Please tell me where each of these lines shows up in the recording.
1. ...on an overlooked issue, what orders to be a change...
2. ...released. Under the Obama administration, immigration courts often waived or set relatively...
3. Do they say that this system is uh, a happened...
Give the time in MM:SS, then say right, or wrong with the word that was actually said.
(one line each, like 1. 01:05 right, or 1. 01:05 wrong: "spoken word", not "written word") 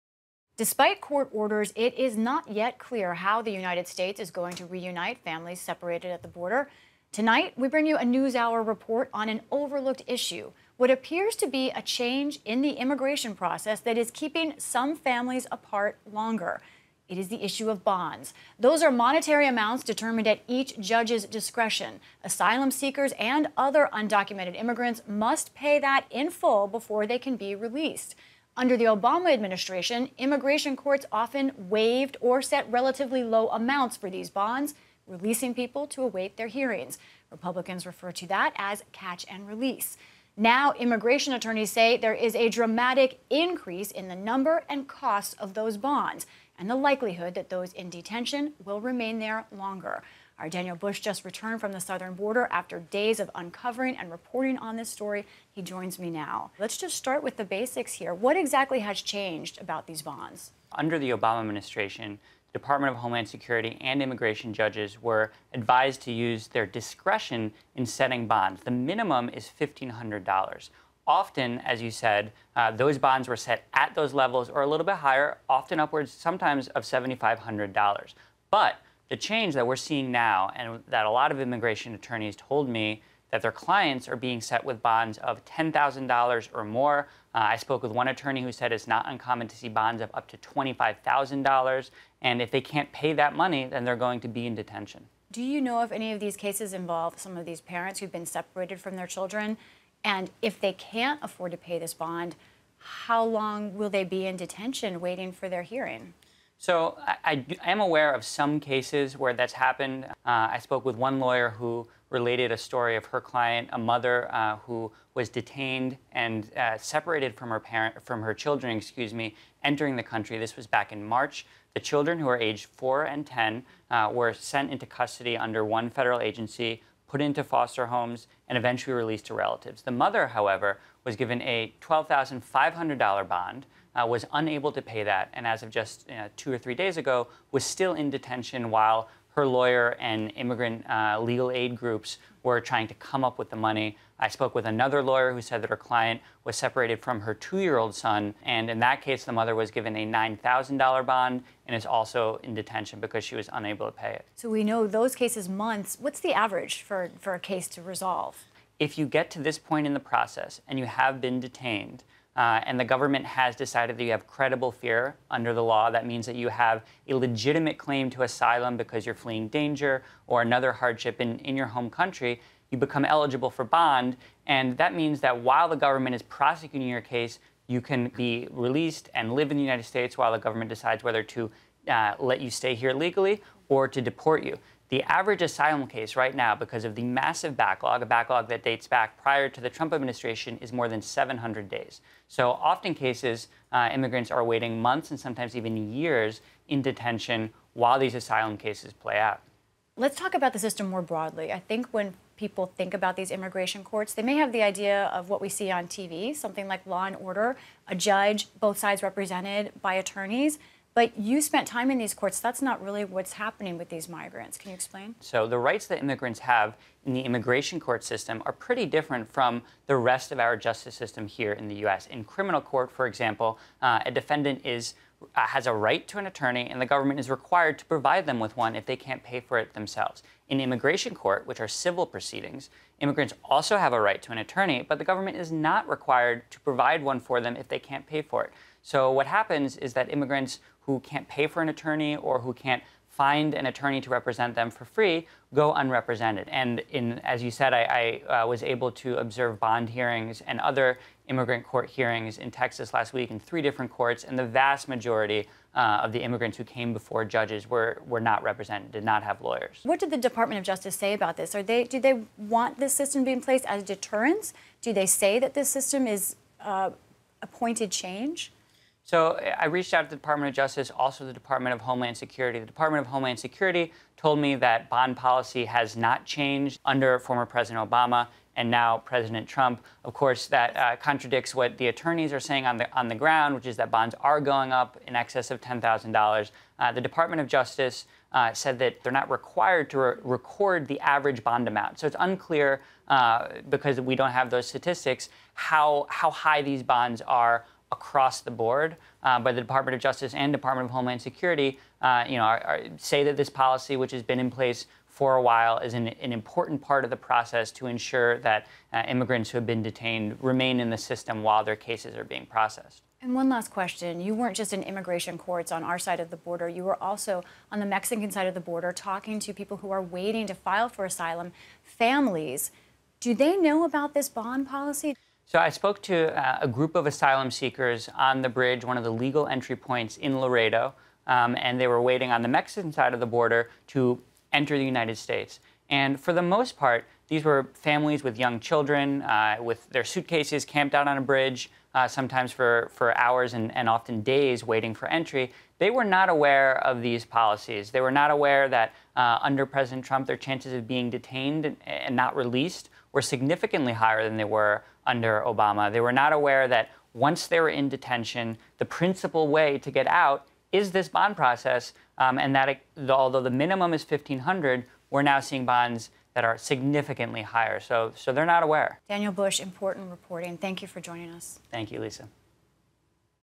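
1. 00:09 wrong: "appears", not "orders"
2. 00:27 right
3. 04:24 wrong: "pointed", not "happened".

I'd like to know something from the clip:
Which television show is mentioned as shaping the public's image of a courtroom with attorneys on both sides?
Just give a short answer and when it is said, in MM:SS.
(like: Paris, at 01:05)
Law and Order, at 03:26.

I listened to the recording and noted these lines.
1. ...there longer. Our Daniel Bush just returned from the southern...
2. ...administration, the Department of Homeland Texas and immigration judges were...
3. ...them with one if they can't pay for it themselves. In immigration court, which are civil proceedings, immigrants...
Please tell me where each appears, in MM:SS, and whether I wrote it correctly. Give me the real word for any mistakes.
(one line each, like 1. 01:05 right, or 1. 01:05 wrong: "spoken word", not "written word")
1. 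00:49 right
2. 01:01 wrong: "Security", not "Texas"
3. 03:48 right.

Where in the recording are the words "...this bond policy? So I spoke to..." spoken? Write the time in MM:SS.
05:24.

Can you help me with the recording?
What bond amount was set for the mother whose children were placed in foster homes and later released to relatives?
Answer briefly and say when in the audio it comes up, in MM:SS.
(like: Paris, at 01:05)
$12,500, at 02:11.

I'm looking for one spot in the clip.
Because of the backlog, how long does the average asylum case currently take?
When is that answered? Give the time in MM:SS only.
03:10.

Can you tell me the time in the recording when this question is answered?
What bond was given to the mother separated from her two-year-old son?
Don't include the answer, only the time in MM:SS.
02:30.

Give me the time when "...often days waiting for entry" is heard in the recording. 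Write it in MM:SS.
05:43.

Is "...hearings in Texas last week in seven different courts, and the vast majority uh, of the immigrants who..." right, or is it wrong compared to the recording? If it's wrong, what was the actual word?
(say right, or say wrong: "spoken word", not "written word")
wrong: "three", not "seven".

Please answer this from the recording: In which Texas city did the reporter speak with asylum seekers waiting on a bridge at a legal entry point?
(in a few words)
Laredo.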